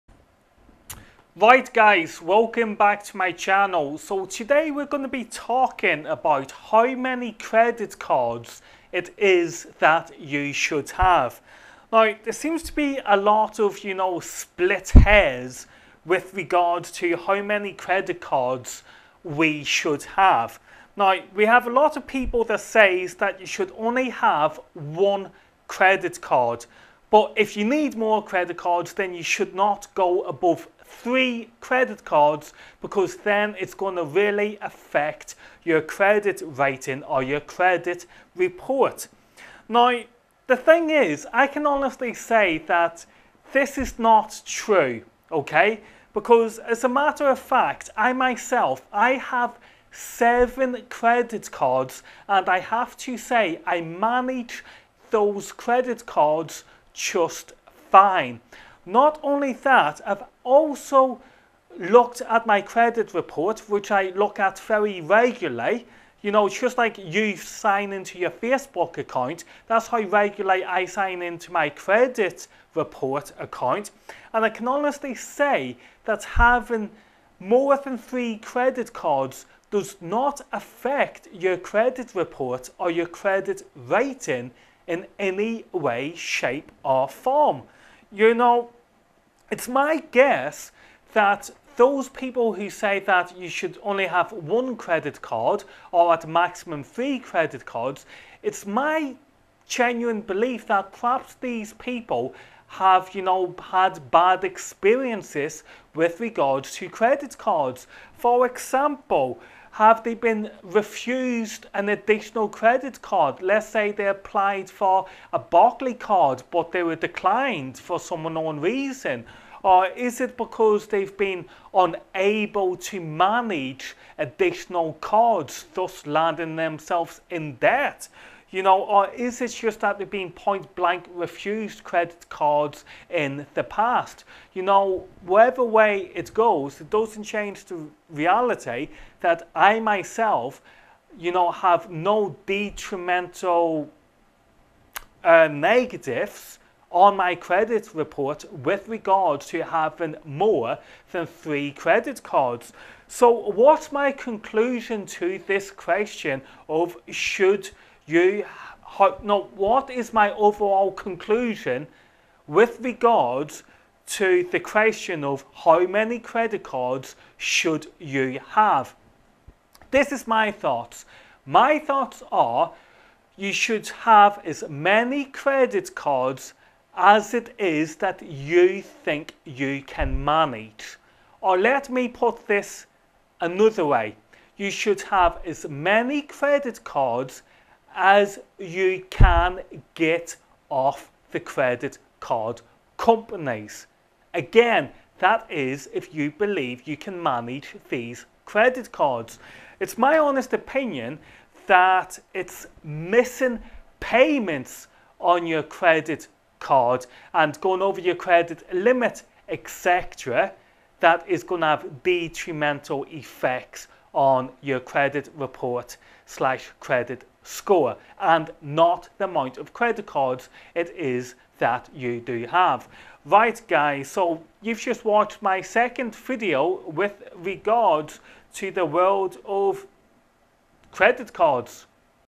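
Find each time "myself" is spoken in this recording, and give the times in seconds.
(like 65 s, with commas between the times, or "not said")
48 s, 139 s.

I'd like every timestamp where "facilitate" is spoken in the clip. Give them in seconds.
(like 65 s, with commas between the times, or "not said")
not said.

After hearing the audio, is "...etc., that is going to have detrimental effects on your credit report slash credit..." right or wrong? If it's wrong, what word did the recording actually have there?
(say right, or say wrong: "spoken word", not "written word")
right.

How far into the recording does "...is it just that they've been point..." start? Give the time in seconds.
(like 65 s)
129 s.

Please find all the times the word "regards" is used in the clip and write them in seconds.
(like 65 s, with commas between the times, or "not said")
16 s, 106 s, 148 s, 162 s, 227 s.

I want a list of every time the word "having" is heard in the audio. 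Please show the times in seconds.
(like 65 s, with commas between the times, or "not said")
76 s, 149 s.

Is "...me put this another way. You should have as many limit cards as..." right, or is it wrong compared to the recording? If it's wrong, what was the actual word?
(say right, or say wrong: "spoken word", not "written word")
wrong: "credit", not "limit".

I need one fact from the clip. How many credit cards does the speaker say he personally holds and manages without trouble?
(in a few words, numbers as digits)
7.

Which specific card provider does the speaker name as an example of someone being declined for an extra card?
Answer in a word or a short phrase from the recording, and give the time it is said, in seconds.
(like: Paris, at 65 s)
Barclaycard, at 115 s.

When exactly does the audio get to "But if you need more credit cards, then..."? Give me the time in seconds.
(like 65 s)
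27 s.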